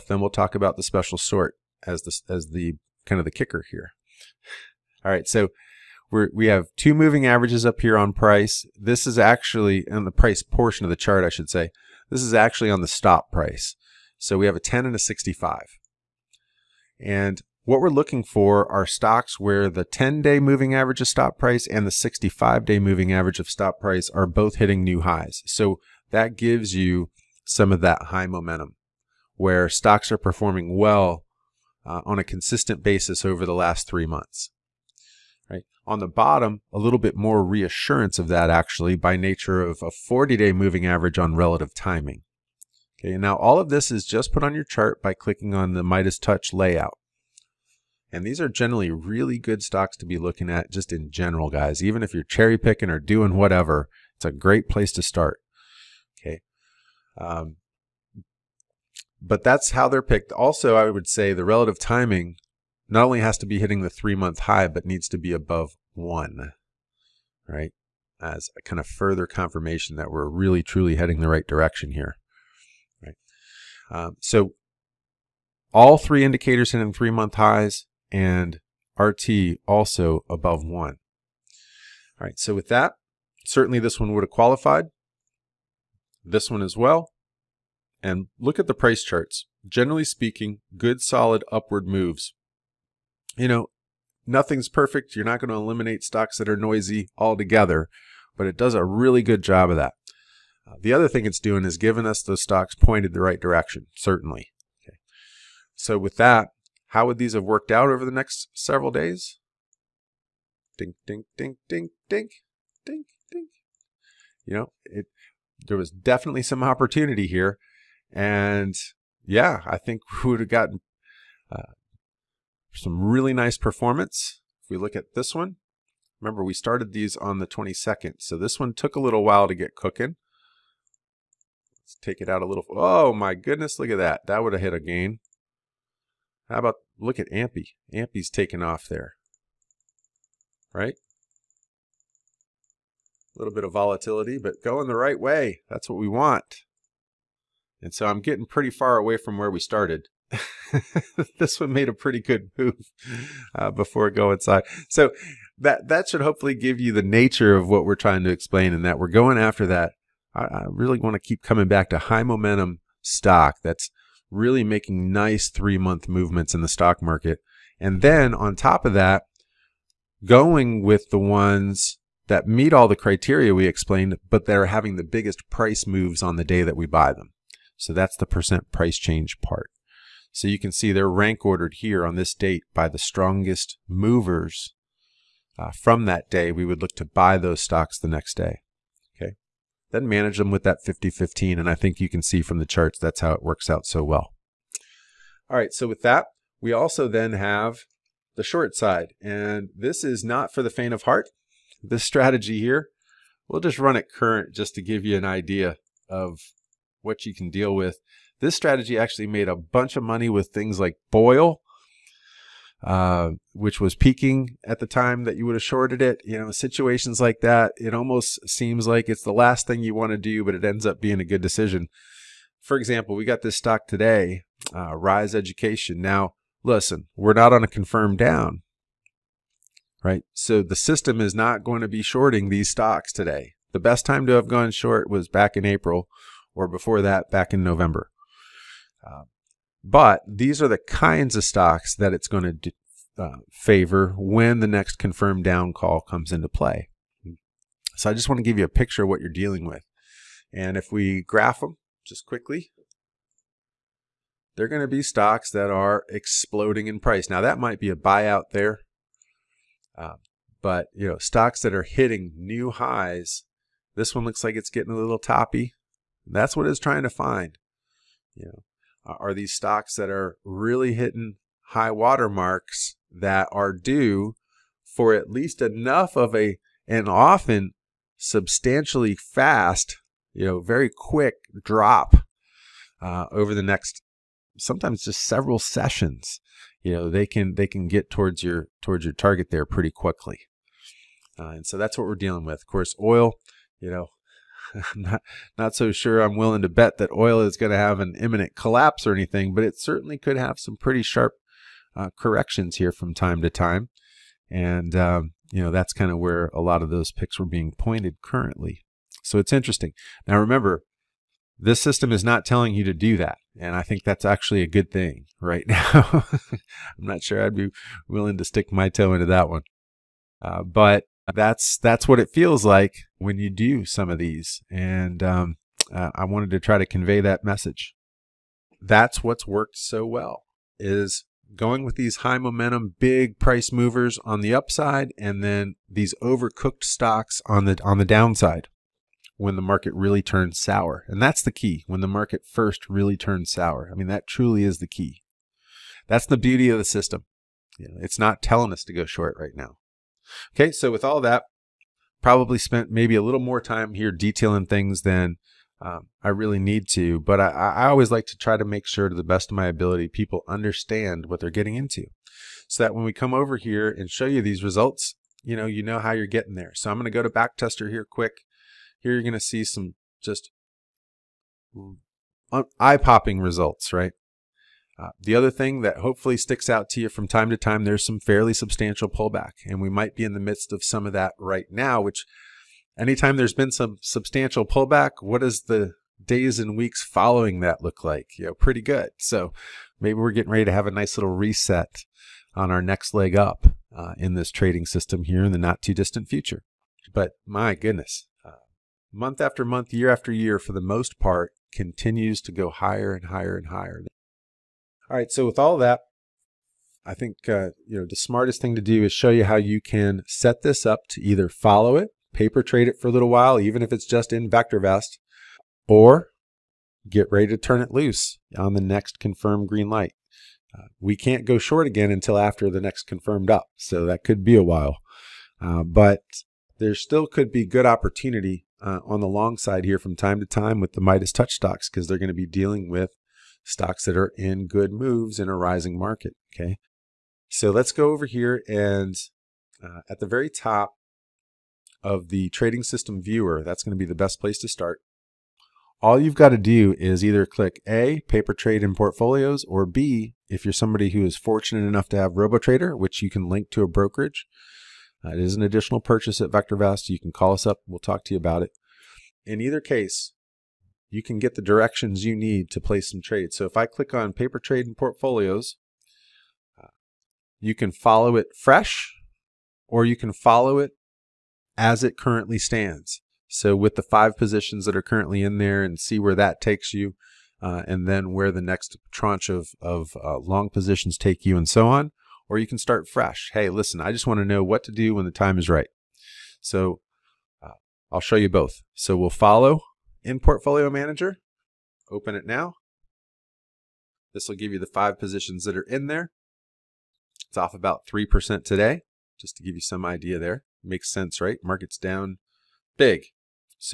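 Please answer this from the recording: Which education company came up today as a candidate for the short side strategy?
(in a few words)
Rise Education.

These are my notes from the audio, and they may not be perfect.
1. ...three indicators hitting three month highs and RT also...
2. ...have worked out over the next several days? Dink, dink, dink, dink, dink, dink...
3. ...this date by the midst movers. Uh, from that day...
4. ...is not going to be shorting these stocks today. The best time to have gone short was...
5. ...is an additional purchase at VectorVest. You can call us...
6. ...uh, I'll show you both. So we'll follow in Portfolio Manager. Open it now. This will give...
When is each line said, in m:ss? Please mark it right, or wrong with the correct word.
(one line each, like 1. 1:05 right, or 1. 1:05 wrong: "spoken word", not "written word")
1. 1:15 right
2. 1:47 right
3. 3:02 wrong: "strongest", not "midst"
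4. 3:51 right
5. 7:35 right
6. 8:07 right.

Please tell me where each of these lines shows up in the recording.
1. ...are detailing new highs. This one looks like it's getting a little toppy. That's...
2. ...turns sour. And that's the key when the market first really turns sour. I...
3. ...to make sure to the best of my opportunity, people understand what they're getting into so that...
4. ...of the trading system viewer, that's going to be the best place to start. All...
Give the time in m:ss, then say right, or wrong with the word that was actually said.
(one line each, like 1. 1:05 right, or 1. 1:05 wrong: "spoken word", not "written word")
1. 4:21 wrong: "hitting", not "detailing"
2. 5:40 right
3. 5:58 wrong: "ability", not "opportunity"
4. 7:22 right.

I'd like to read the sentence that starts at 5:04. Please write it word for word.
And, um, you know, that's kind of where a lot of those picks were being pointed currently.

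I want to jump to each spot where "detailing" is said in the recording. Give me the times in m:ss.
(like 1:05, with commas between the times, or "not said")
5:54.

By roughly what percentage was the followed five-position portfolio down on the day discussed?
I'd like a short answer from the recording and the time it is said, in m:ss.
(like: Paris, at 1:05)
3%, at 8:18.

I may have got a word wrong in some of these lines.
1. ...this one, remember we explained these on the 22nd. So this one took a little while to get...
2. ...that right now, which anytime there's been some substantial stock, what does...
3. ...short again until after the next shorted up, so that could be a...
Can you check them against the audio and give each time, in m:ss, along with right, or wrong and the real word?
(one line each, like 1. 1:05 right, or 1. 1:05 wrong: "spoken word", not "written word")
1. 2:05 wrong: "started", not "explained"
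2. 6:21 wrong: "pullback", not "stock"
3. 7:01 wrong: "confirmed", not "shorted".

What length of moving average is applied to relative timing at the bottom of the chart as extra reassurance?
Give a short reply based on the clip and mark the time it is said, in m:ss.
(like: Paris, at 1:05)
40 day, at 0:39.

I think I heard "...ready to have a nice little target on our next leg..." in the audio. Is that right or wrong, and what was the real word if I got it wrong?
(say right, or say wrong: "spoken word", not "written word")
wrong: "reset", not "target".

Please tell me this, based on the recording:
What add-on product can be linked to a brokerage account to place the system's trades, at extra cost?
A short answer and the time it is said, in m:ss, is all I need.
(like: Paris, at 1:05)
RoboTrader, at 7:32.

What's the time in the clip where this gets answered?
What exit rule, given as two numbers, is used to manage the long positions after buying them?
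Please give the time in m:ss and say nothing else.
3:10.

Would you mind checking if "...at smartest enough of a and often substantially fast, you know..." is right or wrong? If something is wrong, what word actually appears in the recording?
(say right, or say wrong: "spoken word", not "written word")
wrong: "least", not "smartest".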